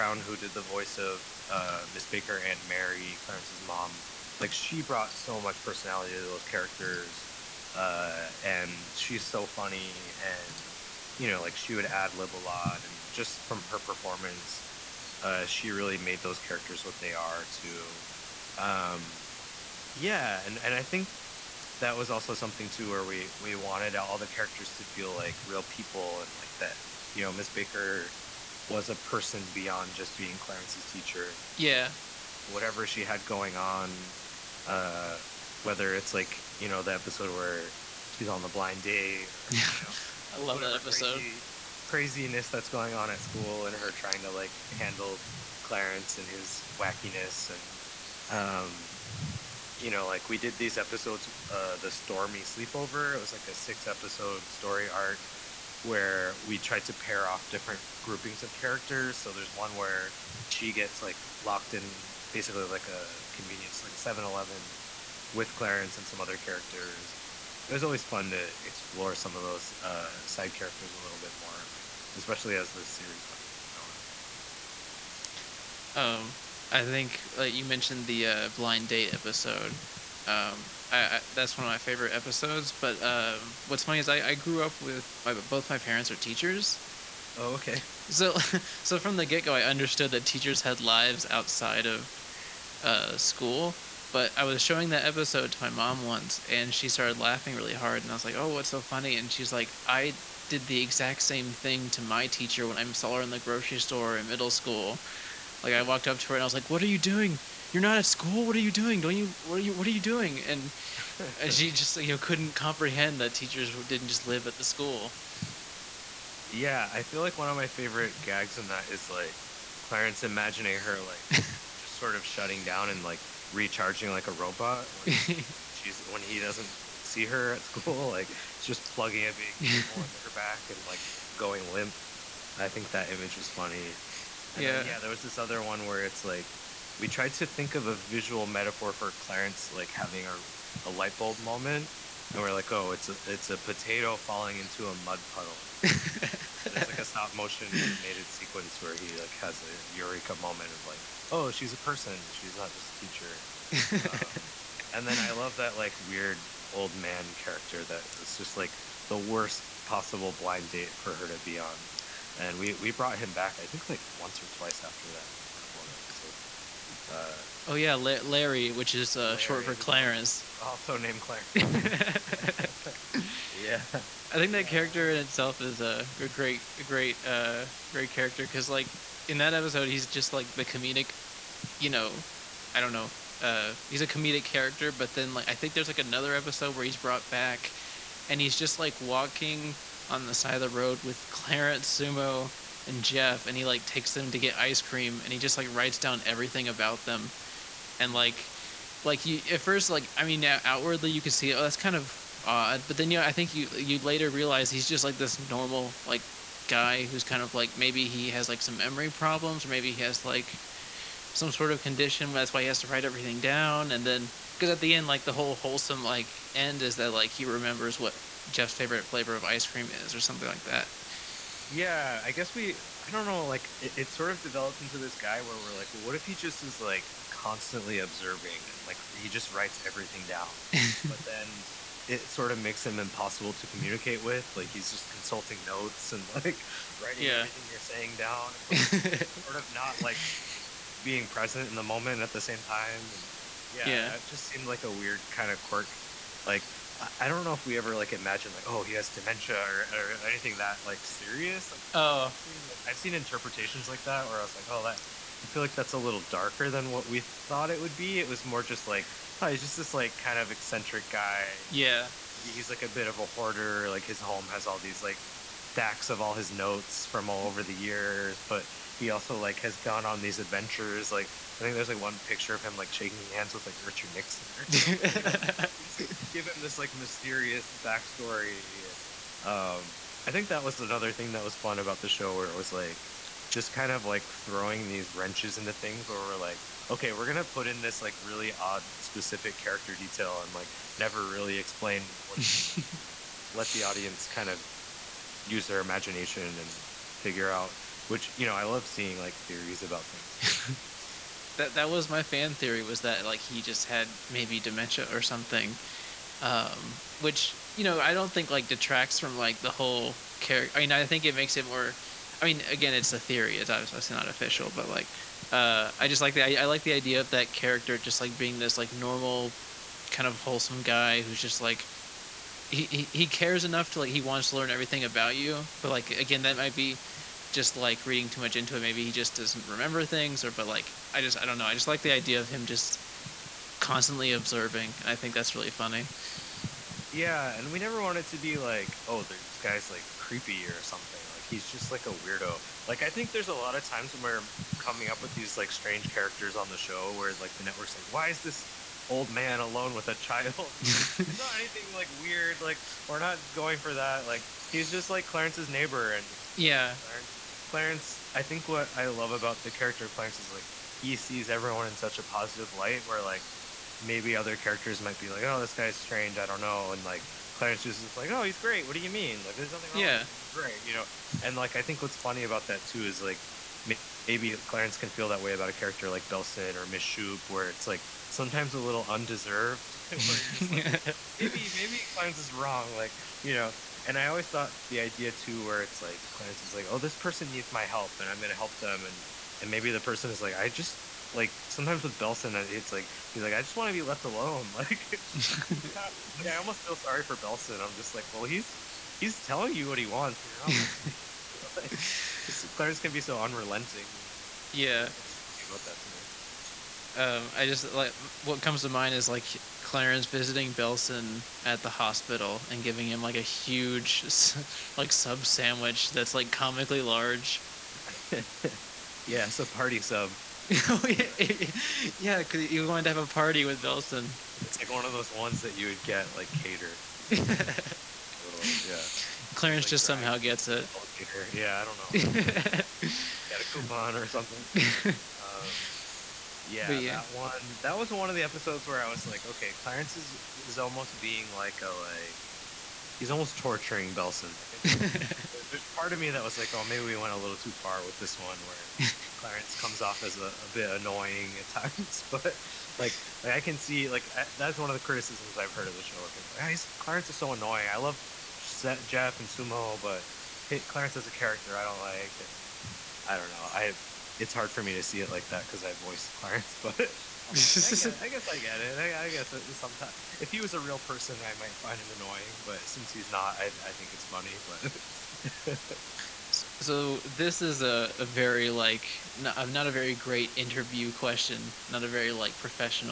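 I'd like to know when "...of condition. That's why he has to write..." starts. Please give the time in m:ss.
3:31.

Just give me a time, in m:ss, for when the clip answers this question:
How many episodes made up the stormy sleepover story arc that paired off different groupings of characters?
0:53.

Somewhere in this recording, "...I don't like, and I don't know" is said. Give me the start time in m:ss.
7:41.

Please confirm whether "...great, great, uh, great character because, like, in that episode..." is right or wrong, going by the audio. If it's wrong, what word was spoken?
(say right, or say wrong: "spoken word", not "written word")
right.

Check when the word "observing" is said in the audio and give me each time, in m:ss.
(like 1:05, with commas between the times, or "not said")
3:47, 5:34.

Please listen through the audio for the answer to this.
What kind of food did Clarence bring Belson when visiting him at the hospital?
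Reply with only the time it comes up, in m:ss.
6:55.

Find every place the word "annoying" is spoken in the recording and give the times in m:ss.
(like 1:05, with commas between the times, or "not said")
7:30, 7:37, 7:52.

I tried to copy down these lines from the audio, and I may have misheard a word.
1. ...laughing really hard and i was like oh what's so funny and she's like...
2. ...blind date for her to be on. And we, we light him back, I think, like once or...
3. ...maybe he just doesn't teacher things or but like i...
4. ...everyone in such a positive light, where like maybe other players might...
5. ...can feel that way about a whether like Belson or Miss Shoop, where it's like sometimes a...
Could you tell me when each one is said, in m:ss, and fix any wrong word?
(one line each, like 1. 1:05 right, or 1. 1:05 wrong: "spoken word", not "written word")
1. 1:37 right
2. 2:40 wrong: "brought", not "light"
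3. 5:28 wrong: "remember", not "teacher"
4. 6:01 wrong: "characters", not "players"
5. 6:14 wrong: "character", not "whether".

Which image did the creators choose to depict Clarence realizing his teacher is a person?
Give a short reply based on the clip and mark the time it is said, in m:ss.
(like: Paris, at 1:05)
A potato falling into a mud puddle, at 2:23.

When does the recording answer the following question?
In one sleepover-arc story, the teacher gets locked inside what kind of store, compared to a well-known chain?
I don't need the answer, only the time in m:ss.
1:03.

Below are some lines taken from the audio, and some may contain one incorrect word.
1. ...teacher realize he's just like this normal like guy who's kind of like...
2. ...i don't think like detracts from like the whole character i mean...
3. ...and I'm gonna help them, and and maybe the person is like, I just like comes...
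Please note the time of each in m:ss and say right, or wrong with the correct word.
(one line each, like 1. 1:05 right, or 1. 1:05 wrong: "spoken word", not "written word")
1. 3:23 wrong: "later", not "teacher"
2. 5:07 right
3. 6:28 wrong: "sometimes", not "comes".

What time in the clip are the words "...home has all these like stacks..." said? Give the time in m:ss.
4:24.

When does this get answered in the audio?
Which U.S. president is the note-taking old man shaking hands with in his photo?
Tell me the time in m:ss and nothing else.
4:33.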